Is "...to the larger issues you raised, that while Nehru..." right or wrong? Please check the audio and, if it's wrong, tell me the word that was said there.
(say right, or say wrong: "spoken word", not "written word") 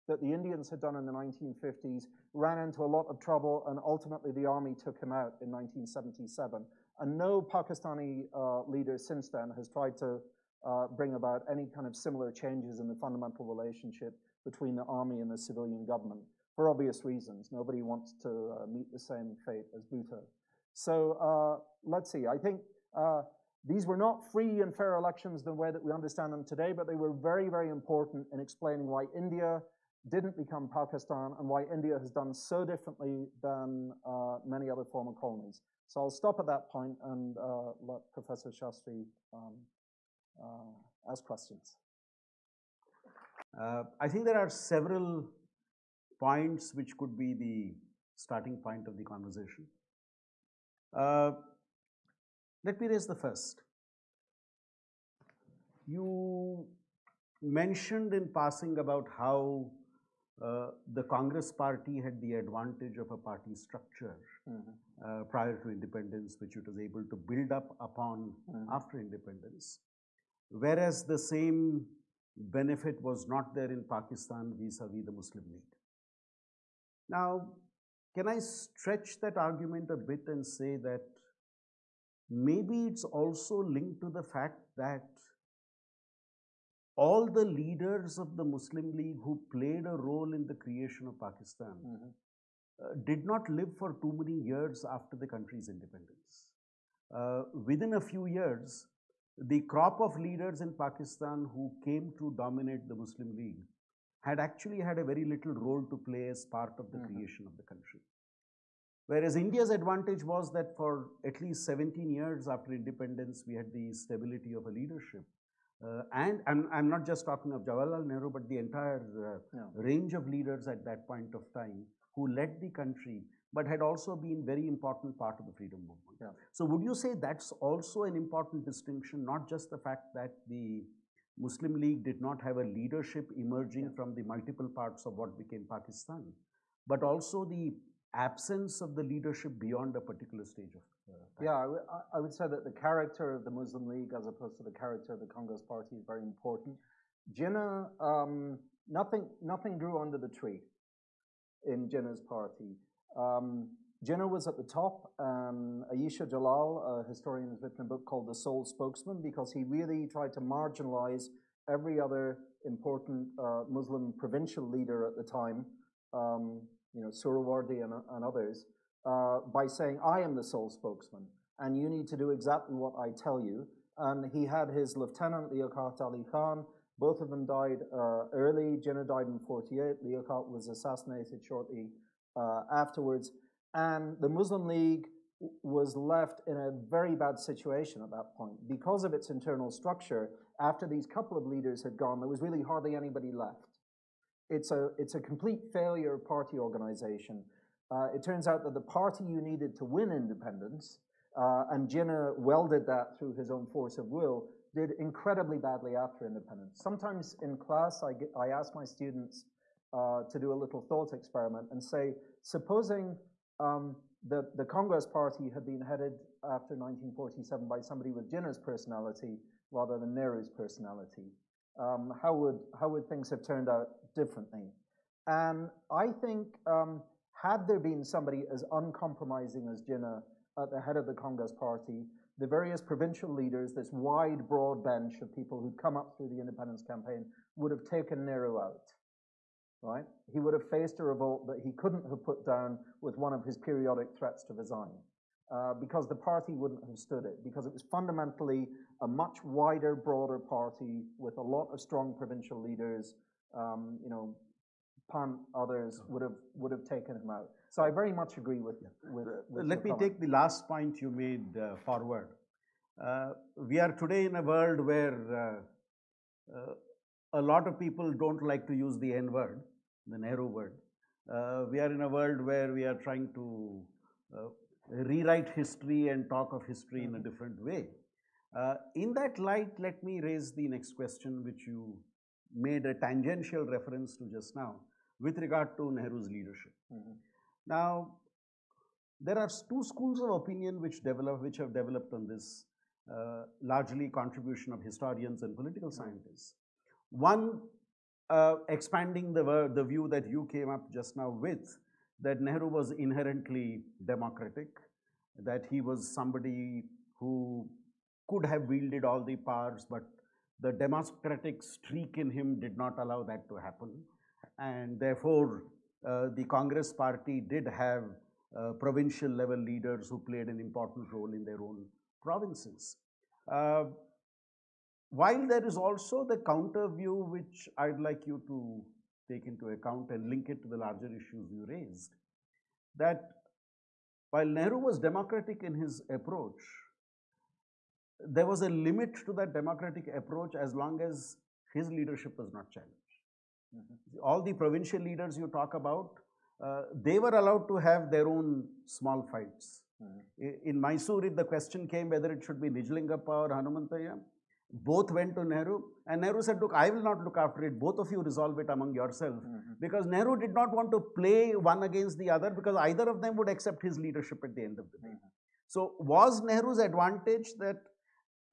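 right.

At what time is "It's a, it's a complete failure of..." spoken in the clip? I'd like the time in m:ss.
3:14.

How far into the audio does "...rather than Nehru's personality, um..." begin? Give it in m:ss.
3:39.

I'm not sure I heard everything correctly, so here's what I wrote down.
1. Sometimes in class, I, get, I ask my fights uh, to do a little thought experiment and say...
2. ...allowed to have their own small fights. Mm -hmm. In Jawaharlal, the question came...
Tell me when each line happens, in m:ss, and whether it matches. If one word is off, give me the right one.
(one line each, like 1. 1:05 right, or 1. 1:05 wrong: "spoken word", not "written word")
1. 3:26 wrong: "students", not "fights"
2. 5:47 wrong: "Mysore", not "Jawaharlal".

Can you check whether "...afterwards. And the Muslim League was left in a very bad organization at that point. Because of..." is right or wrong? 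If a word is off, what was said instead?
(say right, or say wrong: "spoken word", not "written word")
wrong: "situation", not "organization".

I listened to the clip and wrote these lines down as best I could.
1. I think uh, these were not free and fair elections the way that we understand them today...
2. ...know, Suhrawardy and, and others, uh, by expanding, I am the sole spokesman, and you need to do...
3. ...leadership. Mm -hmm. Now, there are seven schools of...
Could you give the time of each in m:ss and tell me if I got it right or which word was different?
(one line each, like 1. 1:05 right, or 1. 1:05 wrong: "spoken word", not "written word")
1. 0:22 right
2. 2:47 wrong: "saying", not "expanding"
3. 4:46 wrong: "two", not "seven".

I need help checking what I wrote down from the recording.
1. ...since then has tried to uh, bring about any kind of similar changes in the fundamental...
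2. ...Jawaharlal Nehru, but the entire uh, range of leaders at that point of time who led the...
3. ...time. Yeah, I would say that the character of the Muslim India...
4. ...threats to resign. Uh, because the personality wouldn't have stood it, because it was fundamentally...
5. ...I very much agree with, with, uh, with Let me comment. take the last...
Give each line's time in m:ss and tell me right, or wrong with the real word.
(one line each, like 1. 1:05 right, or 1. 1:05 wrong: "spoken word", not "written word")
1. 0:08 right
2. 1:57 right
3. 2:21 wrong: "League", not "India"
4. 4:04 wrong: "party", not "personality"
5. 4:17 right.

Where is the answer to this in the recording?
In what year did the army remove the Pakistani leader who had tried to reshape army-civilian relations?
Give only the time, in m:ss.
0:05.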